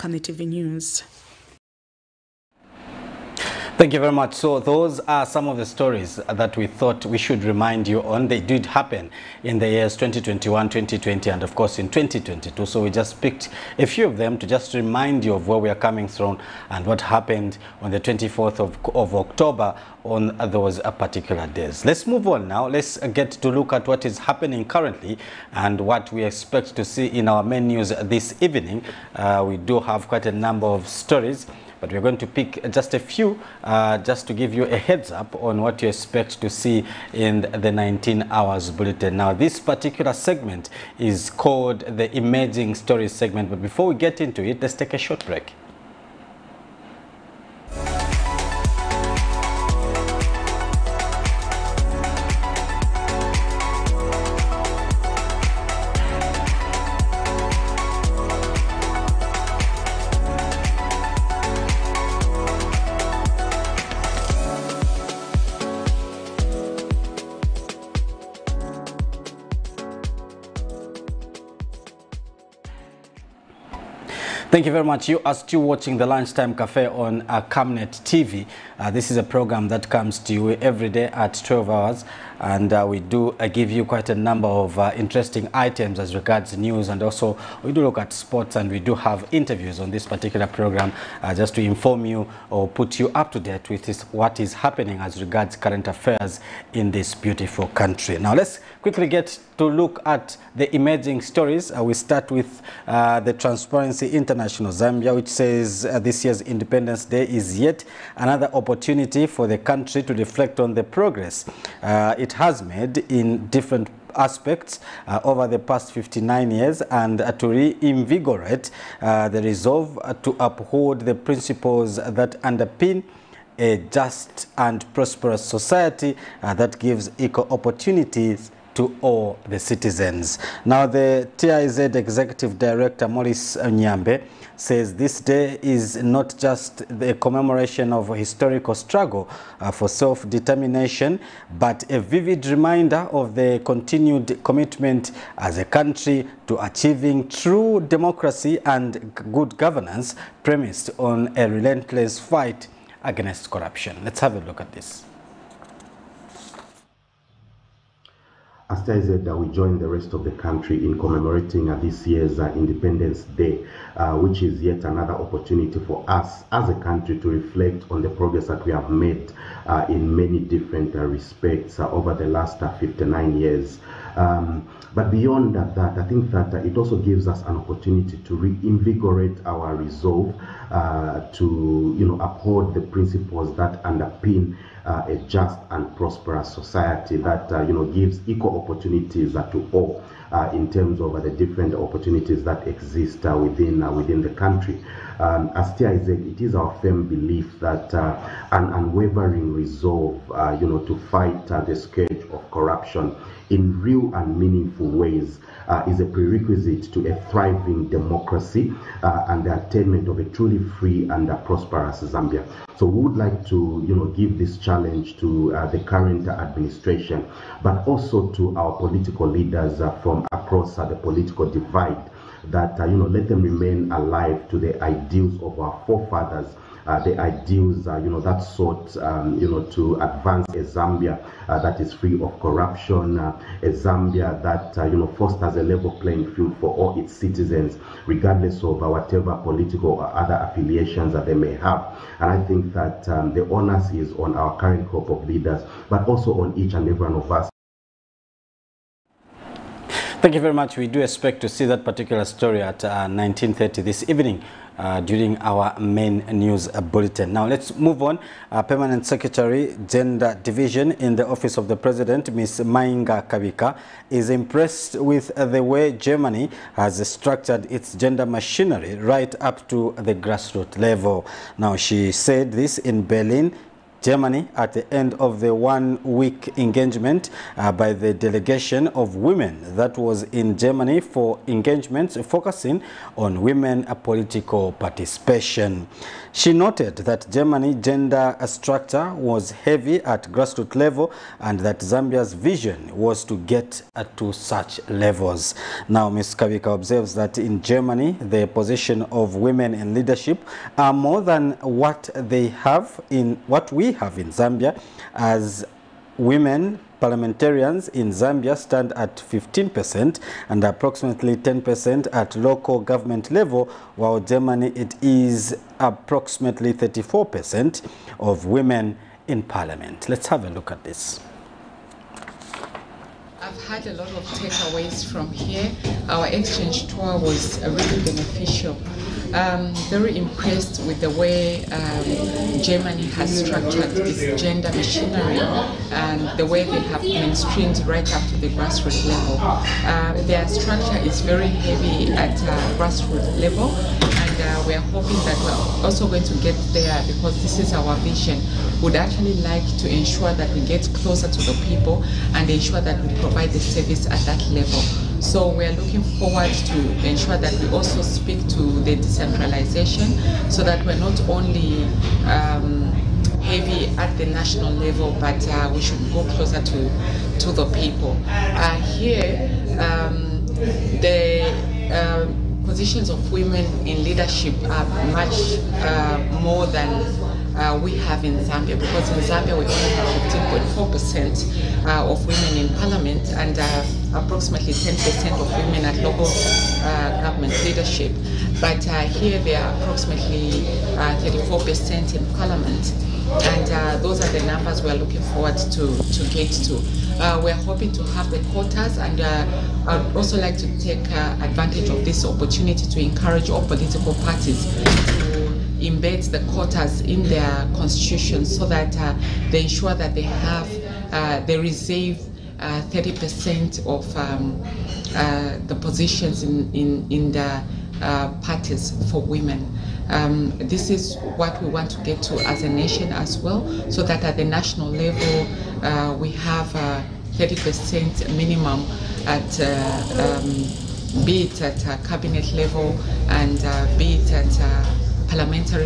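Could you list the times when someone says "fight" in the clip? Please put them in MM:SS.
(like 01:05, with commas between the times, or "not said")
02:32, 03:21.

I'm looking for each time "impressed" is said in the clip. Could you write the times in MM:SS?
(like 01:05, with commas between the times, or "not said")
04:24, 05:30.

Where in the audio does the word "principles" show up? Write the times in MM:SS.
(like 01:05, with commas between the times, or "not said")
02:01, 03:02.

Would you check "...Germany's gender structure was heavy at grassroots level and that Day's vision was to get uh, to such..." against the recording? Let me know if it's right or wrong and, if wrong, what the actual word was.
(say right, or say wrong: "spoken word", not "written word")
wrong: "Zambia", not "Day".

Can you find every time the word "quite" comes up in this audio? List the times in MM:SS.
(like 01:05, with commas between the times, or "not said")
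00:30, 01:23.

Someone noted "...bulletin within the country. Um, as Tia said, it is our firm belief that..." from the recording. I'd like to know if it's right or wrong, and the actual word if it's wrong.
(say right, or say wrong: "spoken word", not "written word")
wrong: "within", not "bulletin".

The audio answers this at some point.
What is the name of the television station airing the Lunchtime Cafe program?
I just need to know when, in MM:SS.
01:17.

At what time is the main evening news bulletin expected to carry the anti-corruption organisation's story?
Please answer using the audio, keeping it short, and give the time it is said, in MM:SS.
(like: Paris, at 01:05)
19:30, at 04:12.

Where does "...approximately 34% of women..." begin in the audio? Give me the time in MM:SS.
05:15.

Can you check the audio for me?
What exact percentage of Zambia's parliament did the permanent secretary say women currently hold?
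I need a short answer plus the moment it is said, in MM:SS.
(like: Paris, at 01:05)
15.4%, at 06:20.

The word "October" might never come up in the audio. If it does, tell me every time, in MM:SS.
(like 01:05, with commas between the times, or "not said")
00:19.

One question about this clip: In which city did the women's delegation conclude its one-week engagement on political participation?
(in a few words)
Berlin.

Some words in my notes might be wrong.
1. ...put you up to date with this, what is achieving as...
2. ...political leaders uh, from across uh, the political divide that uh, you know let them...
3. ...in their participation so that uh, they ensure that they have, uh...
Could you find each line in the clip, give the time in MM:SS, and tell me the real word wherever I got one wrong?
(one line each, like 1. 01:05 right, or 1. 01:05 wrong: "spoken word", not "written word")
1. 01:32 wrong: "happening", not "achieving"
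2. 03:38 right
3. 06:47 wrong: "constitution", not "participation".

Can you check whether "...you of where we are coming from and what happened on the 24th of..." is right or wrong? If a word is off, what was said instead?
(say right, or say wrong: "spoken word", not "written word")
right.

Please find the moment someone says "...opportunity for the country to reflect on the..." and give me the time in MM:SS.
01:48.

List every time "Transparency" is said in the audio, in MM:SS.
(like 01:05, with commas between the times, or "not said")
01:43.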